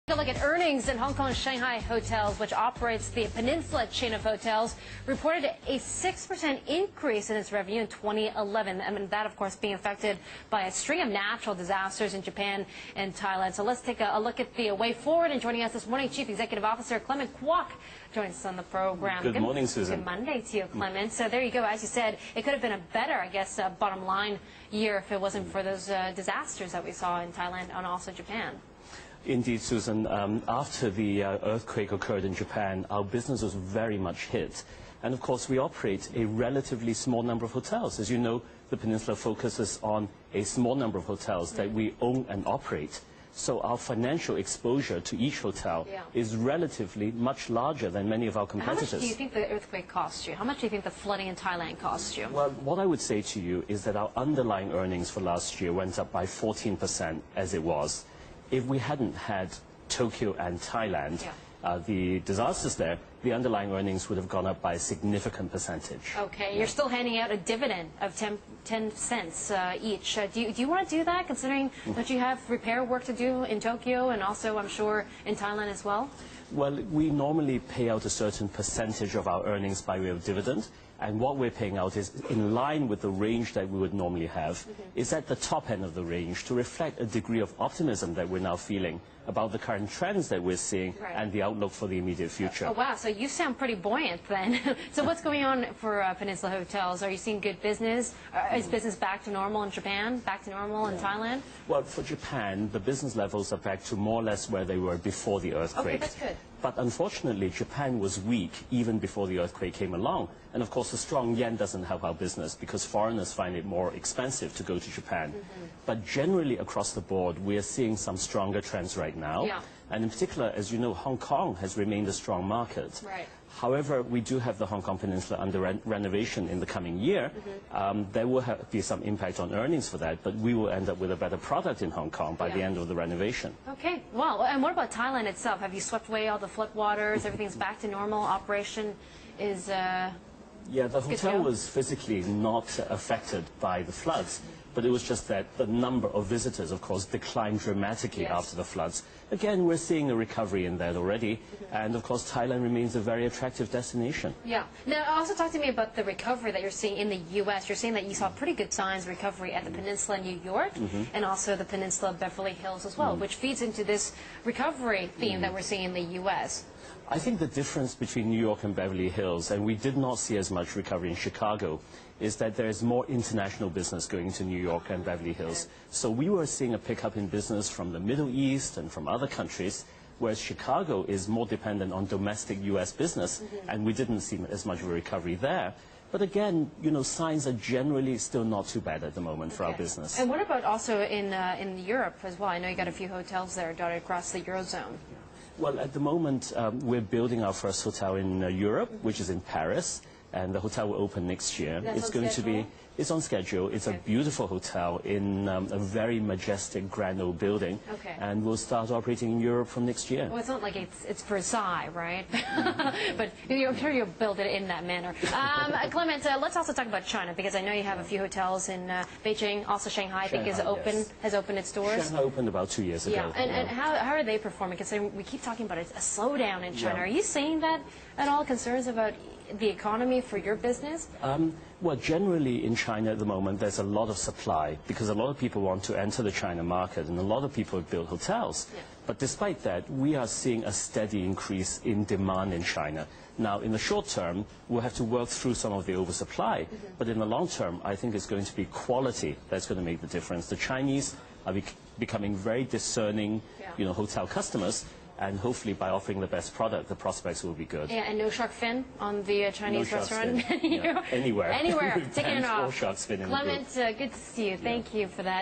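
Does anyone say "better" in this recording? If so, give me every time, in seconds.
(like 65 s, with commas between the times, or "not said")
22 s, 131 s.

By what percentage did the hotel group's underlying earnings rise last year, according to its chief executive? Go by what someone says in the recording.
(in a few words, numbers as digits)
14%.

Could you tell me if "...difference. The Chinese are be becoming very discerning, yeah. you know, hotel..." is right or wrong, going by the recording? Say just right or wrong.
right.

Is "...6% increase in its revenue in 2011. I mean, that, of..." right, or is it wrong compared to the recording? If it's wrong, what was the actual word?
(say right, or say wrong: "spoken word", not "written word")
right.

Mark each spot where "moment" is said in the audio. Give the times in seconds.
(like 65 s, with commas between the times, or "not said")
189 s, 195 s, 233 s.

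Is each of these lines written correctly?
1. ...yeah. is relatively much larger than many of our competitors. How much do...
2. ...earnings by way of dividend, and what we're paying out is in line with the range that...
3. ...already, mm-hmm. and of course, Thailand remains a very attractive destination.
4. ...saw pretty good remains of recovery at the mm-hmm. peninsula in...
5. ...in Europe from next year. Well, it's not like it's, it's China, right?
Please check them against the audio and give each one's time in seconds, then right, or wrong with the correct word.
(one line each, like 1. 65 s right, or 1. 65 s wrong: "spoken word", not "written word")
1. 45 s right
2. 79 s right
3. 150 s right
4. 158 s wrong: "signs", not "remains"
5. 209 s wrong: "Versailles", not "China".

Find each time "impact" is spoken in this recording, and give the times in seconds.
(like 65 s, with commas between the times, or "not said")
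129 s.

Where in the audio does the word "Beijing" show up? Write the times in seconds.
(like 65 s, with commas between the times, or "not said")
219 s.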